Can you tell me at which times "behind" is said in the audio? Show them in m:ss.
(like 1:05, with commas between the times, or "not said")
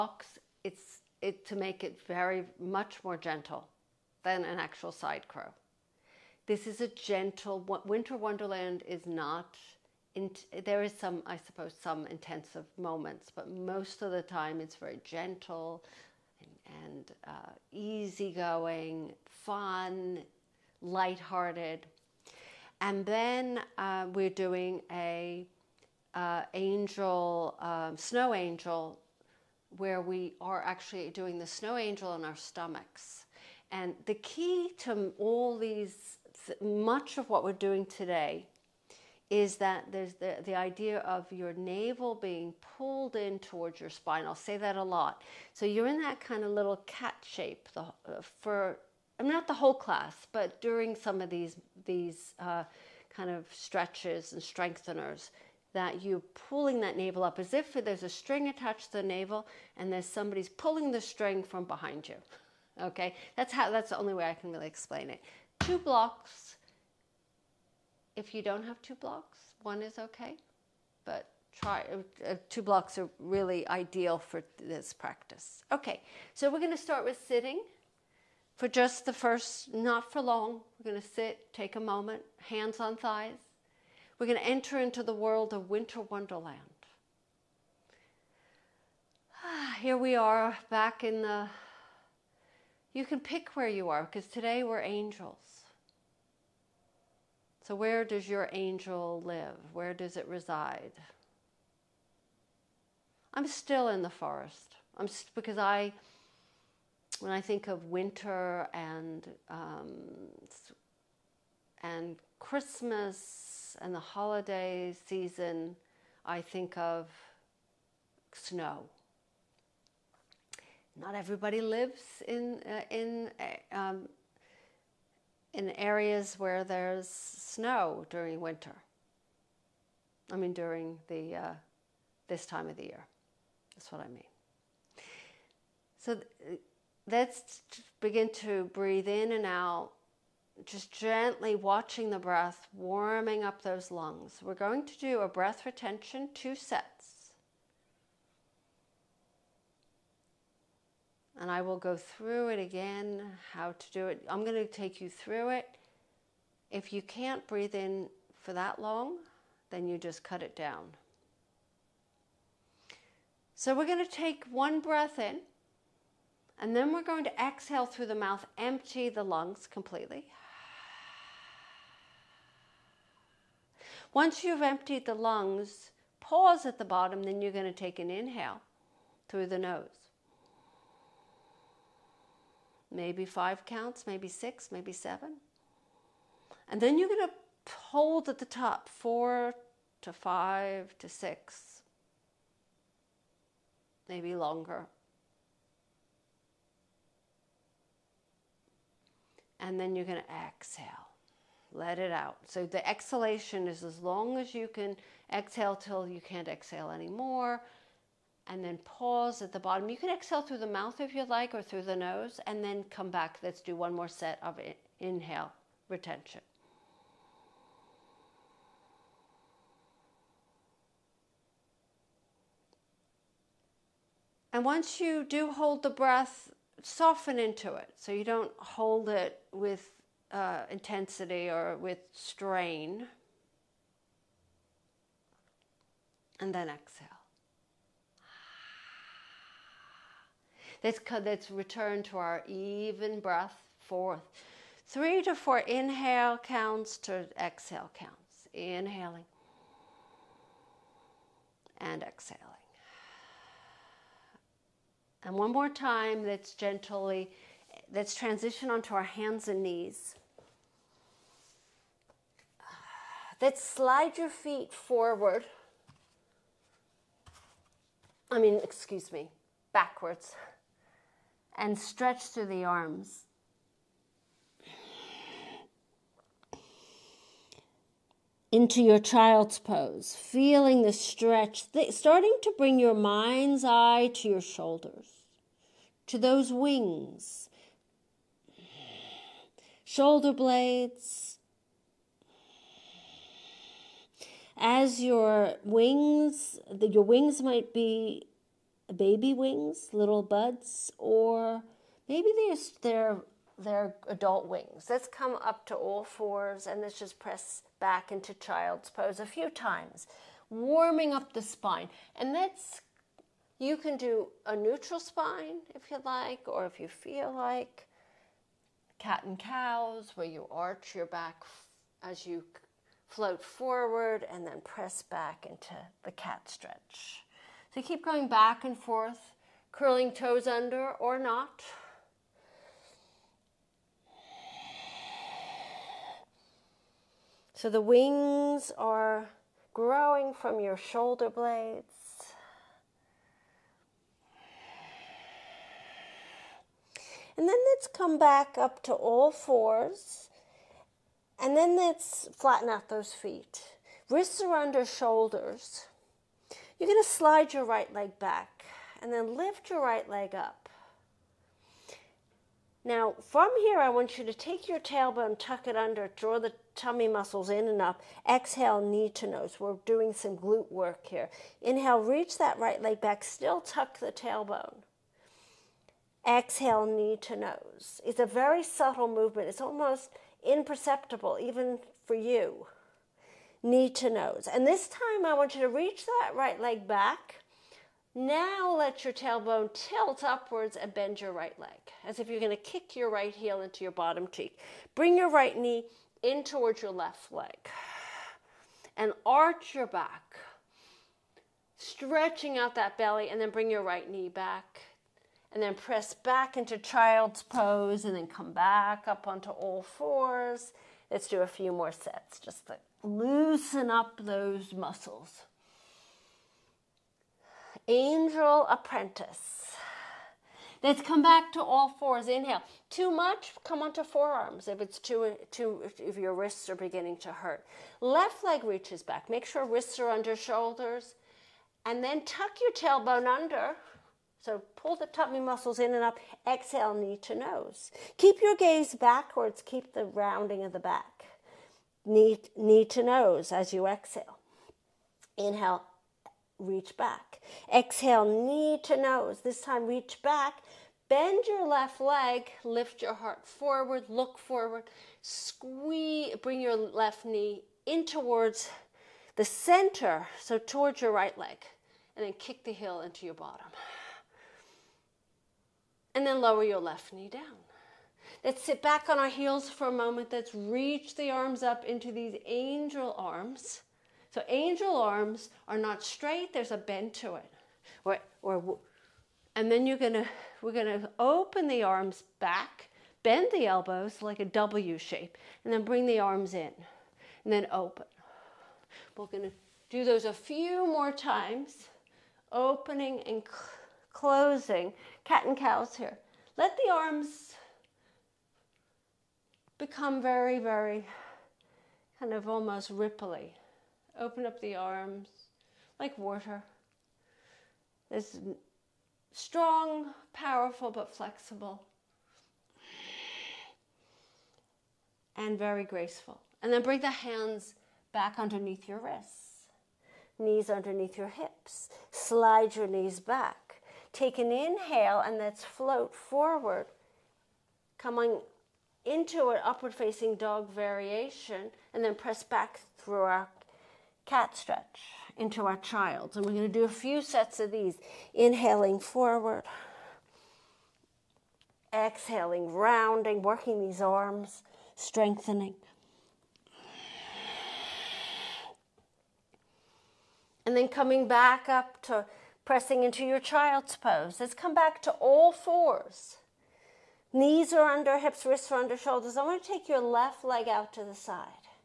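1:01.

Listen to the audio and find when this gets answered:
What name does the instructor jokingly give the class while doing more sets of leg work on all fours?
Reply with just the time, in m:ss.
6:57.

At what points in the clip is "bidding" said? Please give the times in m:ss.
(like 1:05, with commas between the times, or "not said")
not said.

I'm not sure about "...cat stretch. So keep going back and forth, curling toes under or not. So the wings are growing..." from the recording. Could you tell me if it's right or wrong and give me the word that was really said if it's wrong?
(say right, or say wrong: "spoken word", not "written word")
right.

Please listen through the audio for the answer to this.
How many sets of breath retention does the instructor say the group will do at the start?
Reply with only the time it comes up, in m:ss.
2:26.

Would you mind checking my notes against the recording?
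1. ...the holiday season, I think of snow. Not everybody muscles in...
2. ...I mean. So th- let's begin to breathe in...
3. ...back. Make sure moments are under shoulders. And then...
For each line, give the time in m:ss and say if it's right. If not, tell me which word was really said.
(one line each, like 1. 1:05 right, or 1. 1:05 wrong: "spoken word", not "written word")
1. 1:53 wrong: "lives", not "muscles"
2. 2:14 right
3. 7:09 wrong: "wrists", not "moments".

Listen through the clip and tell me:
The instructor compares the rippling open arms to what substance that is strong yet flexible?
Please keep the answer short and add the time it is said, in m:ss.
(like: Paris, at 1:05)
water, at 8:26.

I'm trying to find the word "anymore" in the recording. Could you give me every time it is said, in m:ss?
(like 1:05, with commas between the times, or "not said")
3:26.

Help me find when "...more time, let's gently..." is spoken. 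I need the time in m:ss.
4:15.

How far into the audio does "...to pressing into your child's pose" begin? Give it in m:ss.
9:12.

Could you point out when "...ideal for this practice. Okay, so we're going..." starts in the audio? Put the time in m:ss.
1:13.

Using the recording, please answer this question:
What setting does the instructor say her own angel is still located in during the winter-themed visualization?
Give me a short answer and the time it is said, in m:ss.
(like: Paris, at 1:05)
the forest, at 1:43.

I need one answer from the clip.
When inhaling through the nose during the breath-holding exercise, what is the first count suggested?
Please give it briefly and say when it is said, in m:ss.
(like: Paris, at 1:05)
5, at 3:02.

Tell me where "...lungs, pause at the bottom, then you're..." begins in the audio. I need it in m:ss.
2:55.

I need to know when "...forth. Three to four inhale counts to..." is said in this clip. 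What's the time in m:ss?
4:03.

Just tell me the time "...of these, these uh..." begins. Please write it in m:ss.
0:51.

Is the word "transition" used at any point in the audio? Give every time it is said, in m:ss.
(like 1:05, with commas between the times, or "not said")
4:18.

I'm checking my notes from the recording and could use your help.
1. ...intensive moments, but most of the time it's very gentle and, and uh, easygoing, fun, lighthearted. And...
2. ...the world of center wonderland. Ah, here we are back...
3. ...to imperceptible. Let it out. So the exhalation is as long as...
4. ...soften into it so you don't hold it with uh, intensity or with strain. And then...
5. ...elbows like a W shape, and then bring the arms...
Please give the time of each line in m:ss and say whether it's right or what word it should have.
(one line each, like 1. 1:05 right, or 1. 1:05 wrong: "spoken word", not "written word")
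1. 0:12 right
2. 1:25 wrong: "winter", not "center"
3. 3:20 wrong: "exhale", not "imperceptible"
4. 3:46 right
5. 8:03 right.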